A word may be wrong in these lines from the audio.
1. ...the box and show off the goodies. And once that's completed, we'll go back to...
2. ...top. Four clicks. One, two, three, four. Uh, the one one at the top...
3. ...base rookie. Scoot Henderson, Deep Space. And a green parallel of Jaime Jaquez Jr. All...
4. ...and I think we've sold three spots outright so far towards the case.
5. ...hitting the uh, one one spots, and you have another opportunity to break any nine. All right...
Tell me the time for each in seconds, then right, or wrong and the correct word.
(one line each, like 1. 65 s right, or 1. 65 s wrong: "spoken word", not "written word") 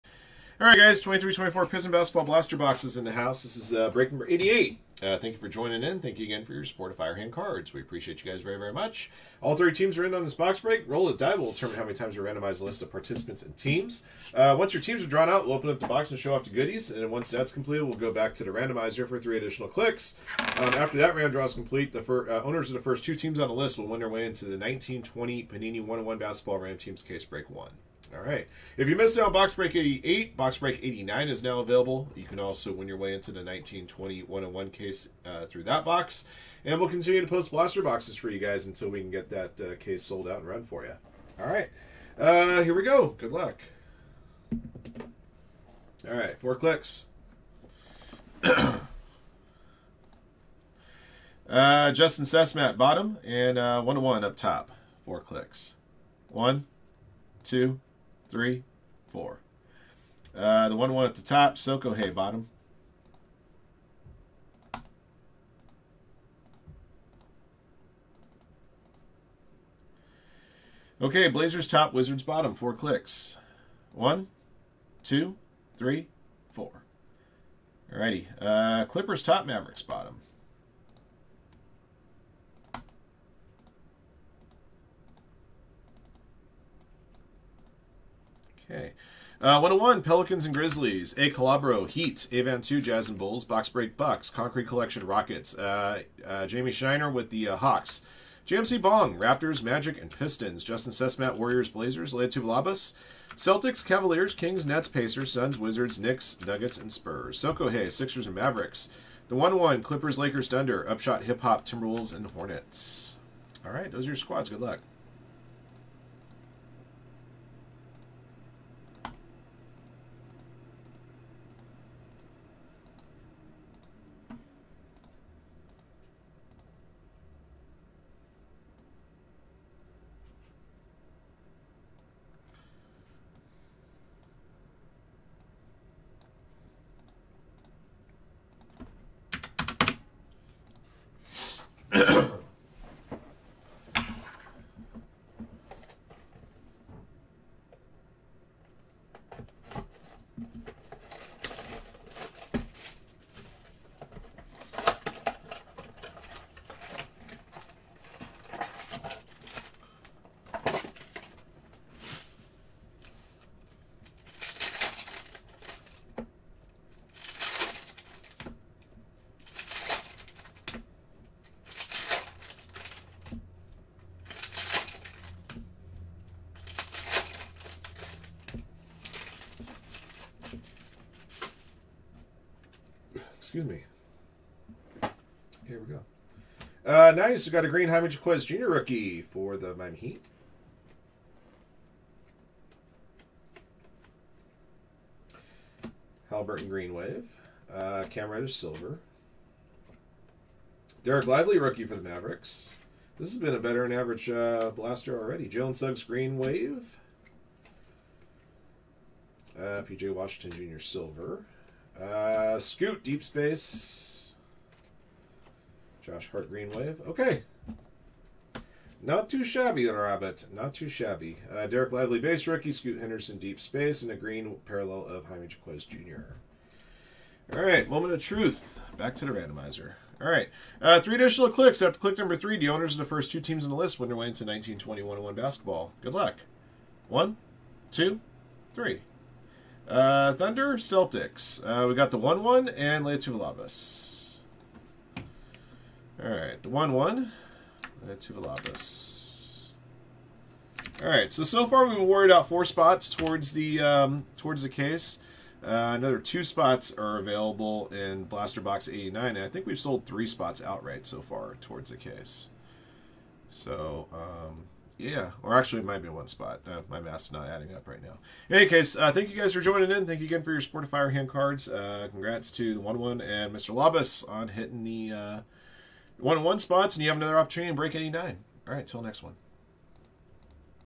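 1. 15 s right
2. 54 s right
3. 222 s right
4. 259 s right
5. 274 s right.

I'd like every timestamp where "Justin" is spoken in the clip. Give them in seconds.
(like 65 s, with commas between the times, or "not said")
51 s, 100 s.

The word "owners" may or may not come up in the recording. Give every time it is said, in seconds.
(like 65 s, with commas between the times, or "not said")
22 s, 232 s.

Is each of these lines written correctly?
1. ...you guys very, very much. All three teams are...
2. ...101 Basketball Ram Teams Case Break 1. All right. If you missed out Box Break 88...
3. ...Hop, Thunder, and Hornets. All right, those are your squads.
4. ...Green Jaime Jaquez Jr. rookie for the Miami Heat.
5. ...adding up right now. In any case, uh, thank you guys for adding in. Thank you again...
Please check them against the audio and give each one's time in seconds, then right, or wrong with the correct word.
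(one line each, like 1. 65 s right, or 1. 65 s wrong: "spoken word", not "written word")
1. 8 s right
2. 25 s right
3. 111 s wrong: "Timberwolves", not "Thunder"
4. 187 s right
5. 267 s wrong: "joining", not "adding".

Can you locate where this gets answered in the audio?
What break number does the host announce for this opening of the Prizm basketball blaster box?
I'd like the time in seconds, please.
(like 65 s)
3 s.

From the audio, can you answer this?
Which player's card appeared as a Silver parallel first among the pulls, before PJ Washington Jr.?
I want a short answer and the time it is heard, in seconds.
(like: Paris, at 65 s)
Cam Reddish, at 198 s.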